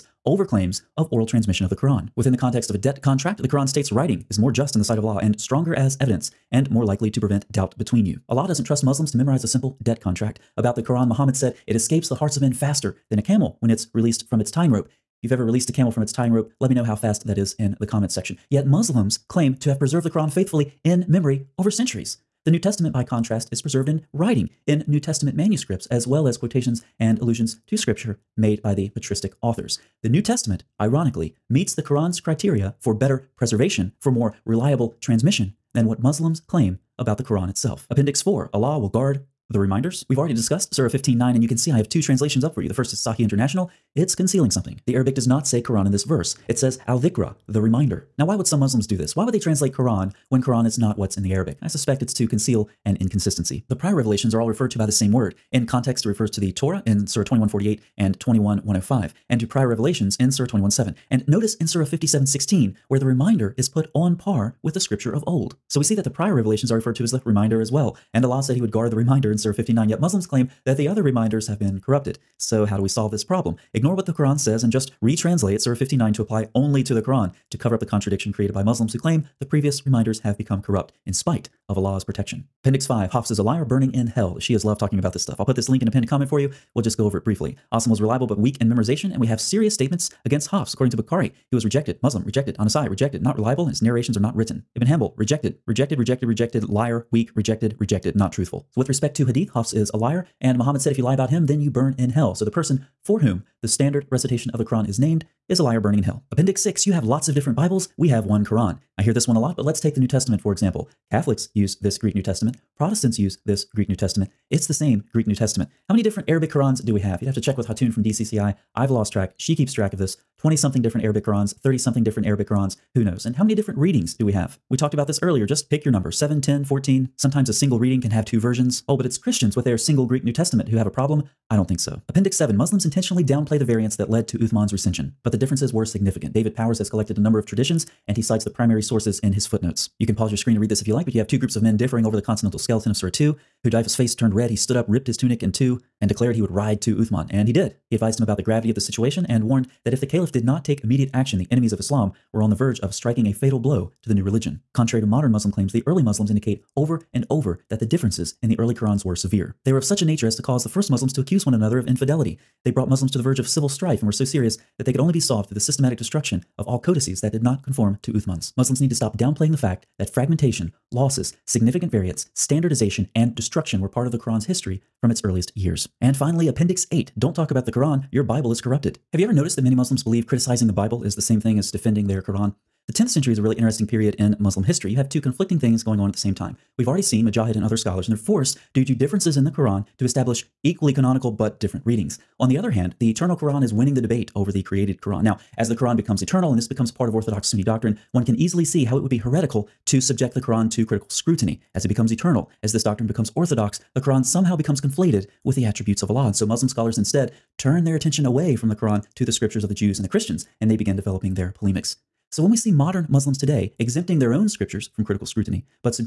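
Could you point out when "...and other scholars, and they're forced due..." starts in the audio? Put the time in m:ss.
3:07.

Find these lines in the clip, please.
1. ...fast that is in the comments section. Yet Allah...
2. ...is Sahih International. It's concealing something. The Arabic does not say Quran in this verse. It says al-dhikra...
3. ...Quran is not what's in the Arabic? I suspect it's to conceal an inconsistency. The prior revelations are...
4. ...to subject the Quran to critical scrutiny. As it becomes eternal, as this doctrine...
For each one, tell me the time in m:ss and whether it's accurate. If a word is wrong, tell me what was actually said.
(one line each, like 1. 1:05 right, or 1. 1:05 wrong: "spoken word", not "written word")
1. 0:16 wrong: "Muslims", not "Allah"
2. 0:42 right
3. 0:50 right
4. 3:19 right.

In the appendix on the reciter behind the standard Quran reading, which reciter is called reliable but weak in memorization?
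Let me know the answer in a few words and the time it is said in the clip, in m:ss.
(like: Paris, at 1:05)
Asim, at 1:27.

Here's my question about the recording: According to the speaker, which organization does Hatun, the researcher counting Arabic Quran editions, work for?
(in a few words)
DCCI.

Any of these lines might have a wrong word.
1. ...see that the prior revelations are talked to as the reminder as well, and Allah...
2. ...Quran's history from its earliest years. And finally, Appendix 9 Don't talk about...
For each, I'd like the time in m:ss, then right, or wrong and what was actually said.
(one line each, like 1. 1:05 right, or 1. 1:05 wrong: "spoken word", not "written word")
1. 1:05 wrong: "referred", not "talked"
2. 2:54 wrong: "8", not "9".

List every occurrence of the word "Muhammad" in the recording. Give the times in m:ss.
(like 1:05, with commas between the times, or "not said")
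0:11, 1:40.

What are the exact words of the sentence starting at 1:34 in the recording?
Ibn Hanbal, rejected, rejected, rejected, rejected, liar, weak, rejected, rejected, not truthful.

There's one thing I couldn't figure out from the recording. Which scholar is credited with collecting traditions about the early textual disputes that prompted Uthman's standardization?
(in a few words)
David Powers.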